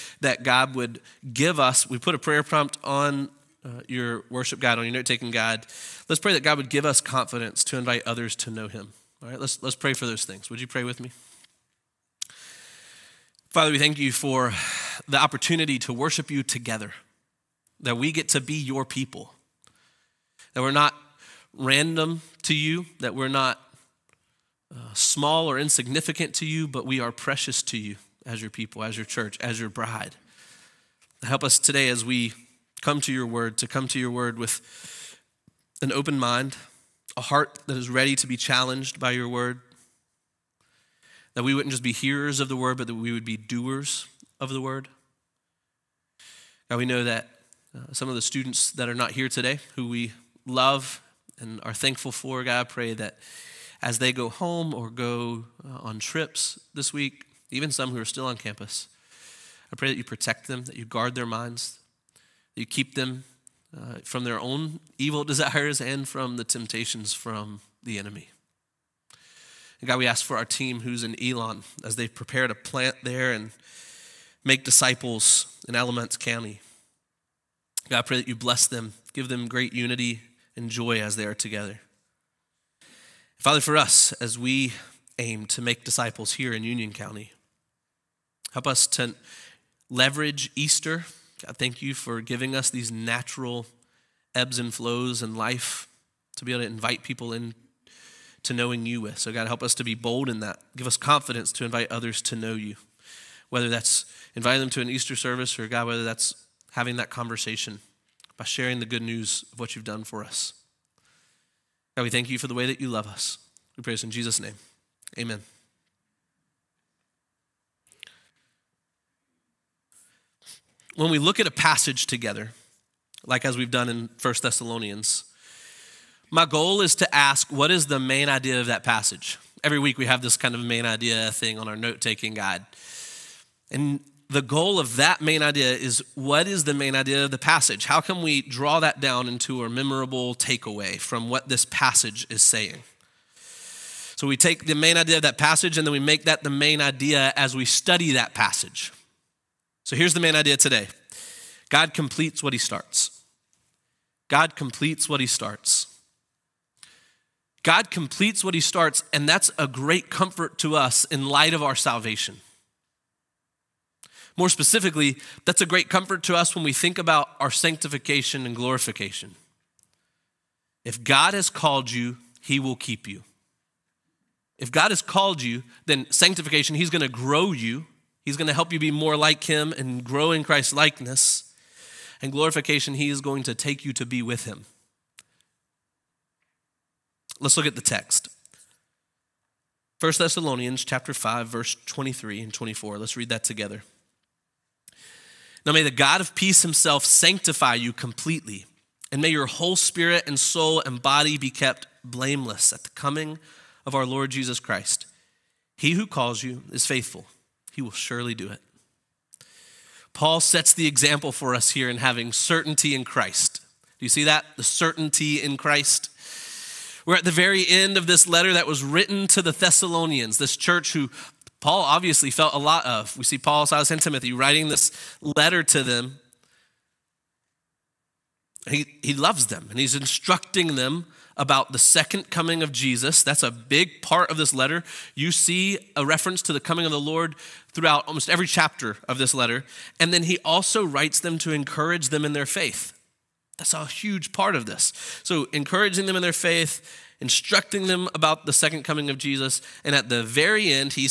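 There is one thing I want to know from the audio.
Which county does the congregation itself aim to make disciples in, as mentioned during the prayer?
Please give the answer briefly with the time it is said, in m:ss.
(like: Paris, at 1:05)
Union County, at 1:26.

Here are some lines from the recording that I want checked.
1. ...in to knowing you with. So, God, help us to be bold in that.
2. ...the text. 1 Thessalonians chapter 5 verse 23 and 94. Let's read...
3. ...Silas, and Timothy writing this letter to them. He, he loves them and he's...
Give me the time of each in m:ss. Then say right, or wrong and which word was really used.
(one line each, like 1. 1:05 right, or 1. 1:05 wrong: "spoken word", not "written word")
1. 1:37 right
2. 3:07 wrong: "24", not "94"
3. 3:43 right.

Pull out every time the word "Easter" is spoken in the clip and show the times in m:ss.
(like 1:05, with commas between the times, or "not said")
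1:30, 1:44.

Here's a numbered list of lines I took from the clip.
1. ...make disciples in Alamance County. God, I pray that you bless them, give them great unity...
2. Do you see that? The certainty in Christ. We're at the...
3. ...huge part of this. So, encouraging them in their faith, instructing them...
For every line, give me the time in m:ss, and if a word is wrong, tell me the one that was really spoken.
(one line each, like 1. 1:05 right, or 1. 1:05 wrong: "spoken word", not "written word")
1. 1:14 right
2. 3:33 right
3. 4:03 right.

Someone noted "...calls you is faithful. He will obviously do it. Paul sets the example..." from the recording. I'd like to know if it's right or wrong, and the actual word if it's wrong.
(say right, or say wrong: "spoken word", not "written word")
wrong: "surely", not "obviously".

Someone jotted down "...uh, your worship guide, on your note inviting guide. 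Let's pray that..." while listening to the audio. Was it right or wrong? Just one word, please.
wrong.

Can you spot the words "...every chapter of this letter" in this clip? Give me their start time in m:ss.
3:58.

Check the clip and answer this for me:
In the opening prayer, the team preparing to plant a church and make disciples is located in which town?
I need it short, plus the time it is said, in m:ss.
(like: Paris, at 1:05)
Elon, at 1:11.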